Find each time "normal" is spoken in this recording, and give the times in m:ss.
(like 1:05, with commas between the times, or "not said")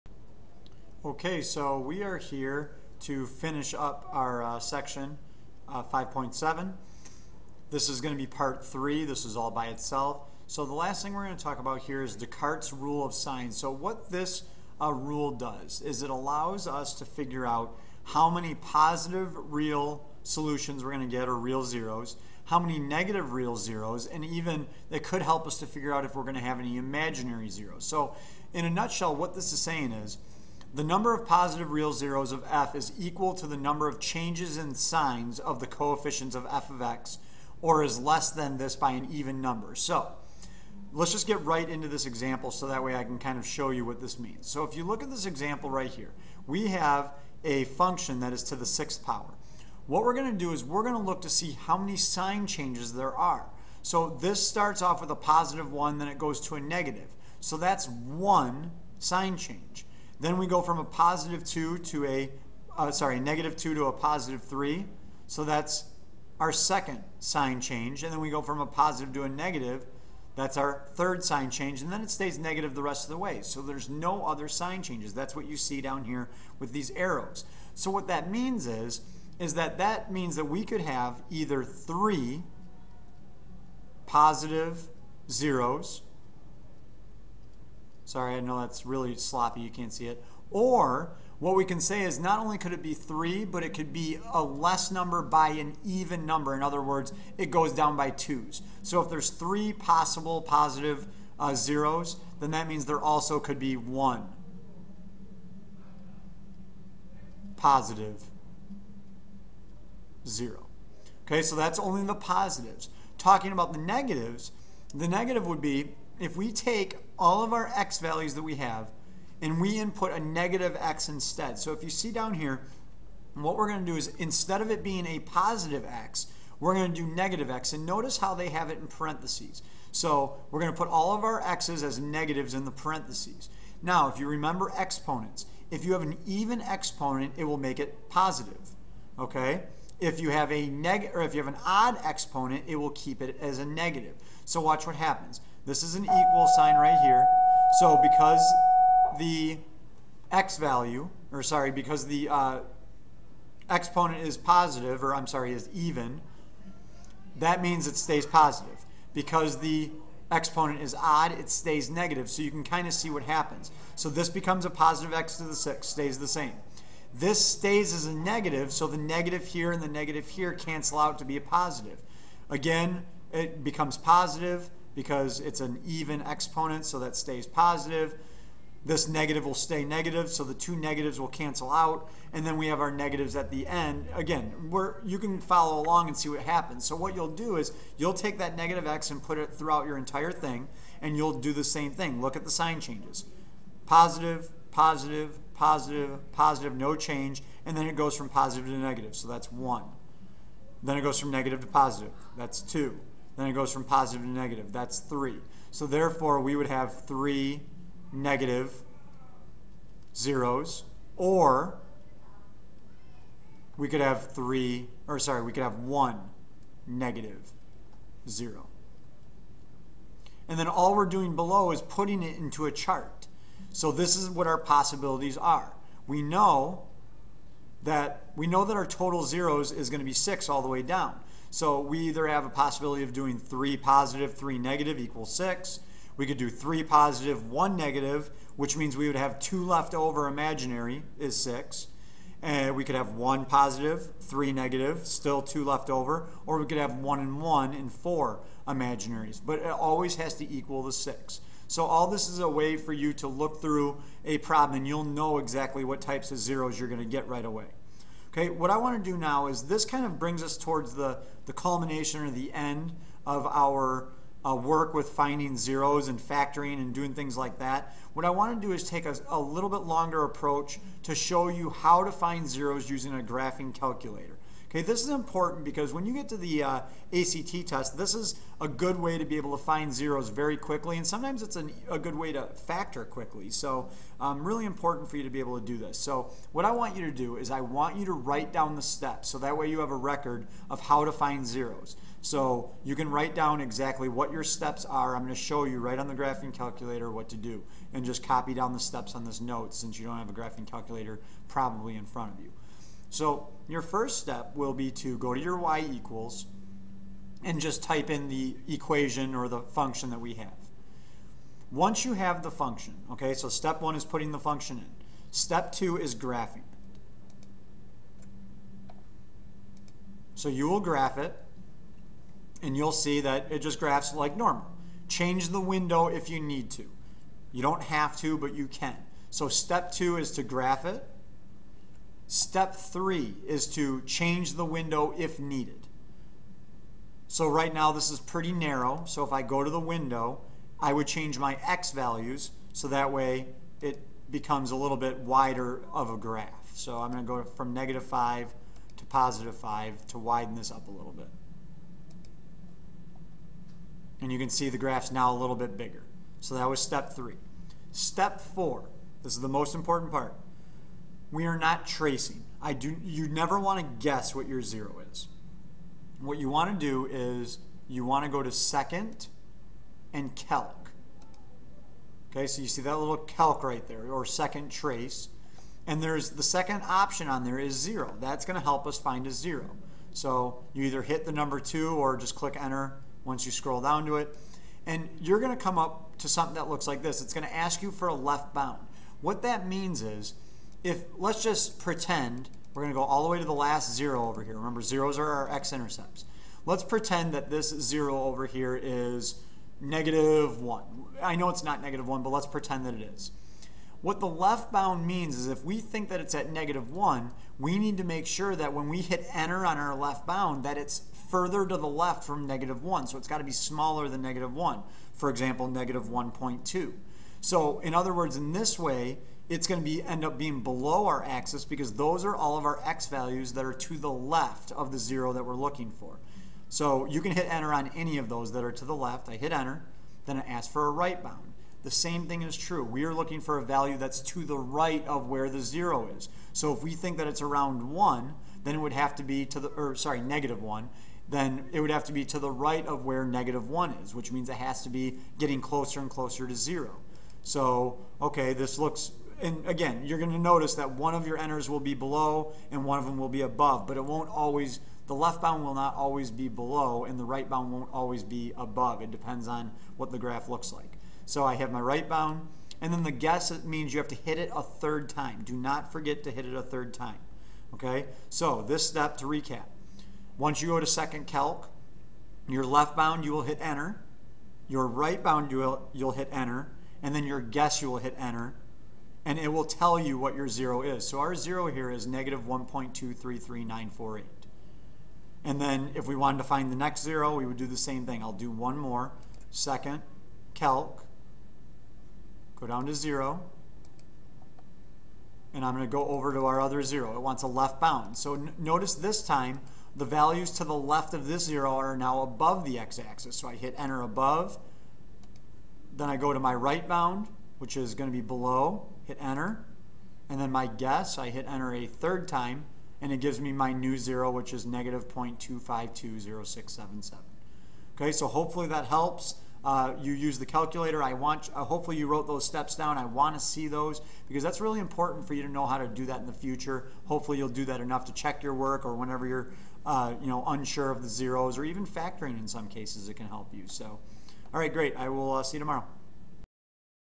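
5:24.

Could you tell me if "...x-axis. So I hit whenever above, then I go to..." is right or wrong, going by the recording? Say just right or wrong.
wrong.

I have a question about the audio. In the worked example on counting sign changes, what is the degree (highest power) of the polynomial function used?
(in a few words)
6.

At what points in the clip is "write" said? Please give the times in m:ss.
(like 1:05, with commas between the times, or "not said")
4:48, 4:53.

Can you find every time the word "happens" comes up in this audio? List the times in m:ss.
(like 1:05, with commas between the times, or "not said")
2:24, 2:43, 3:06.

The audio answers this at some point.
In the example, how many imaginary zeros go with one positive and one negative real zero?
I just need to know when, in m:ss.
4:07.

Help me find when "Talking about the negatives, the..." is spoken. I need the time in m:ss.
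1:53.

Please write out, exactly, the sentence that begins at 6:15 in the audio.
And there's the second option on there is zero.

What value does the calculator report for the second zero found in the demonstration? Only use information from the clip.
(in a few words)
-0.2520677.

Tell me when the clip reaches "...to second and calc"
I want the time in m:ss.
6:08.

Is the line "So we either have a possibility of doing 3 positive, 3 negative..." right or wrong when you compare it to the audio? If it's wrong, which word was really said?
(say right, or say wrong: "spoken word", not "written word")
right.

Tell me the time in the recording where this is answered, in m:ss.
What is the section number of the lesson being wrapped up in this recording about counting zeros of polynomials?
0:05.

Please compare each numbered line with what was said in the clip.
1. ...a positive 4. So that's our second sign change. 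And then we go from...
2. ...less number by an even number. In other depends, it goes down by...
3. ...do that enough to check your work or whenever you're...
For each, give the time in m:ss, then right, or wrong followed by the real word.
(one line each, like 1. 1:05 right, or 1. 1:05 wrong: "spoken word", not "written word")
1. 1:03 wrong: "3", not "4"
2. 1:34 wrong: "words", not "depends"
3. 8:47 right.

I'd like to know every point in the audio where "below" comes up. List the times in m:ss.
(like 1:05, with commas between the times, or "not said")
3:41, 7:00, 7:31, 7:36, 8:28.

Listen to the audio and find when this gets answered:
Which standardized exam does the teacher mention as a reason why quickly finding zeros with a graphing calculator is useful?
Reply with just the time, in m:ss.
4:37.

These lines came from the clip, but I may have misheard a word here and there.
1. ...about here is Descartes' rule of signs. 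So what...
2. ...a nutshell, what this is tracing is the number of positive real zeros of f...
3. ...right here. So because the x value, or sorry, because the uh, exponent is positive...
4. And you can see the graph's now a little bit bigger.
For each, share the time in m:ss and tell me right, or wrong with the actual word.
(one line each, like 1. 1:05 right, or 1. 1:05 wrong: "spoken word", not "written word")
1. 0:11 right
2. 0:28 wrong: "saying", not "tracing"
3. 2:26 right
4. 5:54 right.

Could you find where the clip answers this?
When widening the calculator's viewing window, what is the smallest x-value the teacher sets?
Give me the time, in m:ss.
5:47.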